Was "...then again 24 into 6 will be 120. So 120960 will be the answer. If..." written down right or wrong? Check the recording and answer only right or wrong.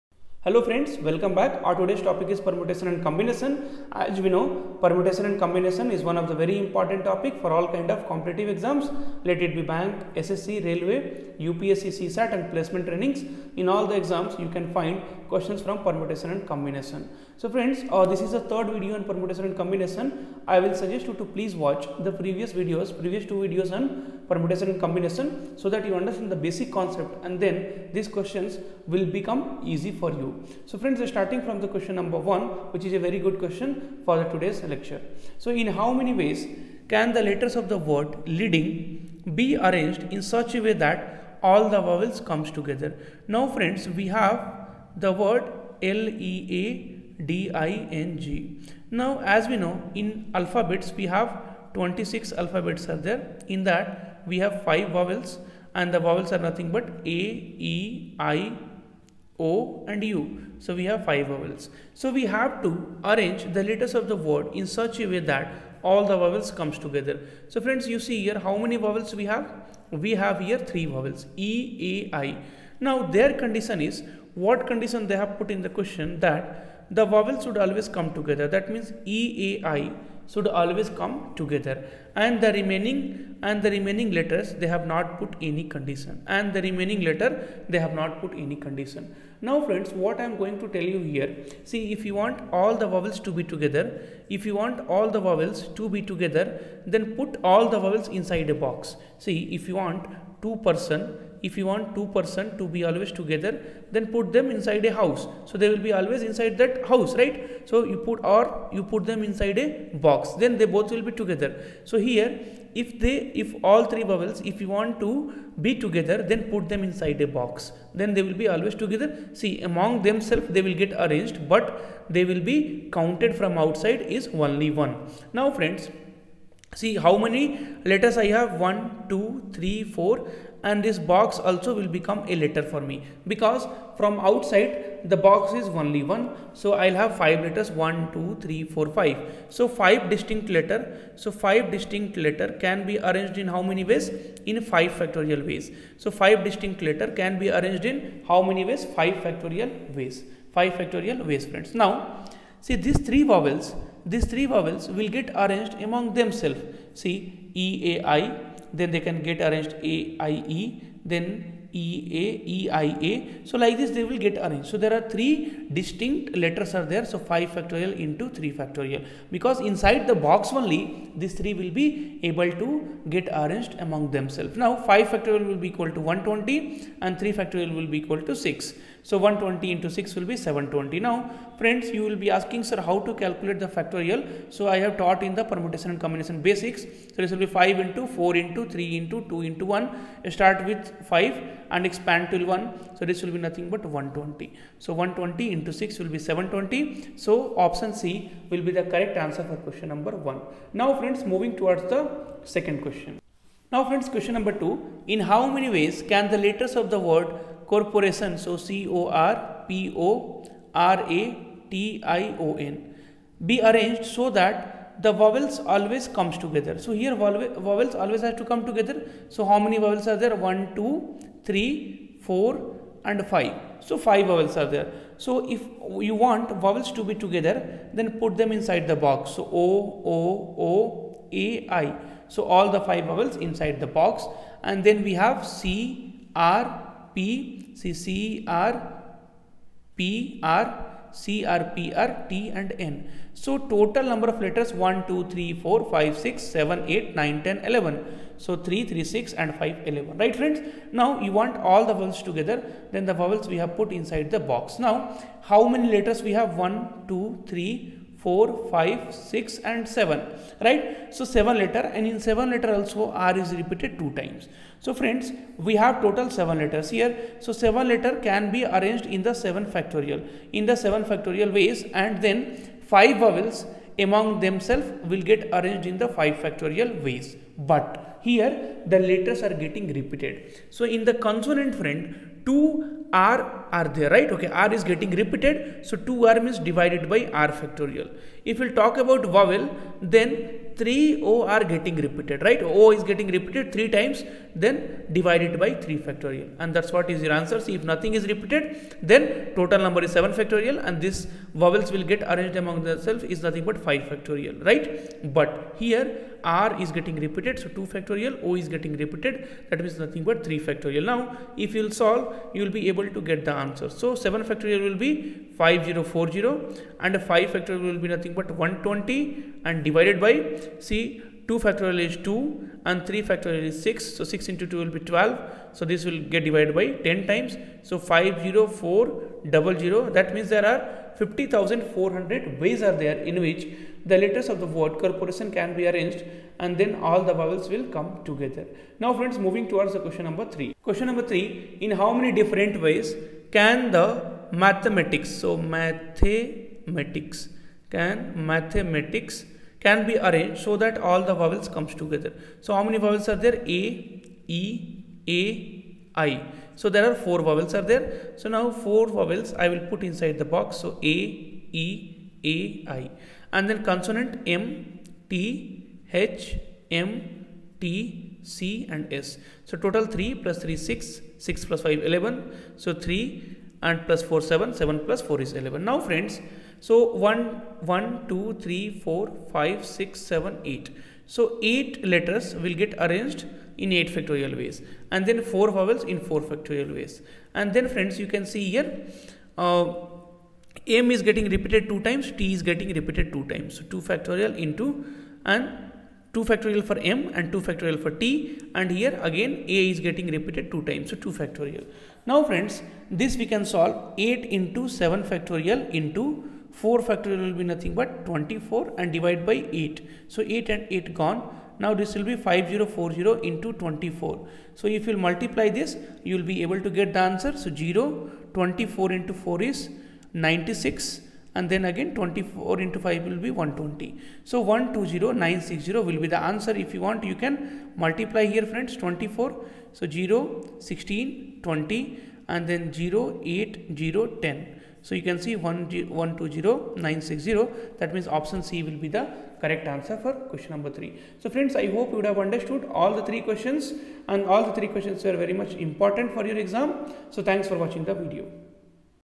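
wrong.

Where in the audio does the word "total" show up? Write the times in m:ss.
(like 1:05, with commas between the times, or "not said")
4:03, 4:26, 4:59, 6:09.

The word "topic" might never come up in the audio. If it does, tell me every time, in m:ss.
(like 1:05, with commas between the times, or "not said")
0:02, 0:07.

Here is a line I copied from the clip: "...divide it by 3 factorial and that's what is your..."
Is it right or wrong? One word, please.
right.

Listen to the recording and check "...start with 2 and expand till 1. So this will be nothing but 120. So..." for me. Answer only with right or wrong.
wrong.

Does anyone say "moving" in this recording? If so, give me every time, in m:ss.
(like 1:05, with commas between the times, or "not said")
3:21, 5:39.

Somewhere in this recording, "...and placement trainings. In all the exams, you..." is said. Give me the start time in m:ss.
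0:12.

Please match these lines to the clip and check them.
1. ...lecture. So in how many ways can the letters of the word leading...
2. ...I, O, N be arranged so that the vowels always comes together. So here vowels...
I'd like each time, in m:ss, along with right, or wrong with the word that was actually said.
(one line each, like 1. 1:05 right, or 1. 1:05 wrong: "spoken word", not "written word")
1. 0:34 right
2. 3:32 right.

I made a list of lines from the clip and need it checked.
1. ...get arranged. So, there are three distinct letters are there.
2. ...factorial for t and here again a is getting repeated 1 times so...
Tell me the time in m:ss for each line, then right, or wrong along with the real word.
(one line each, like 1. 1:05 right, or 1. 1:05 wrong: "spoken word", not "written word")
1. 2:44 right
2. 6:37 wrong: "2", not "1".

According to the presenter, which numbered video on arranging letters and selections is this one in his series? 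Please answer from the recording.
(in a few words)
third.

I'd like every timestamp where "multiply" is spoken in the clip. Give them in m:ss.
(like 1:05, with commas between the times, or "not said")
6:55, 7:07.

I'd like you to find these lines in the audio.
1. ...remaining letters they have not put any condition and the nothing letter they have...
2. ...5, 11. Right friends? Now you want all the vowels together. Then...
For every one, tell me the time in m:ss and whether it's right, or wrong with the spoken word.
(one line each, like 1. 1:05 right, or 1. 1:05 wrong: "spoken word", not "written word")
1. 1:23 wrong: "remaining", not "nothing"
2. 4:09 right.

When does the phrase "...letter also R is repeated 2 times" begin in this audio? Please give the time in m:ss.
4:22.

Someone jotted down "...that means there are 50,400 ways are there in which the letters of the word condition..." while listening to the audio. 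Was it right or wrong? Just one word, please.
wrong.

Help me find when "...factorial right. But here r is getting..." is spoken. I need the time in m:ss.
5:04.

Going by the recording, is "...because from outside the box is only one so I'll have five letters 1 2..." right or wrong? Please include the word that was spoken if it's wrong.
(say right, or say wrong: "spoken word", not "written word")
right.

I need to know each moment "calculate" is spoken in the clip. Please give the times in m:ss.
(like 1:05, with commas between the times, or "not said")
3:03.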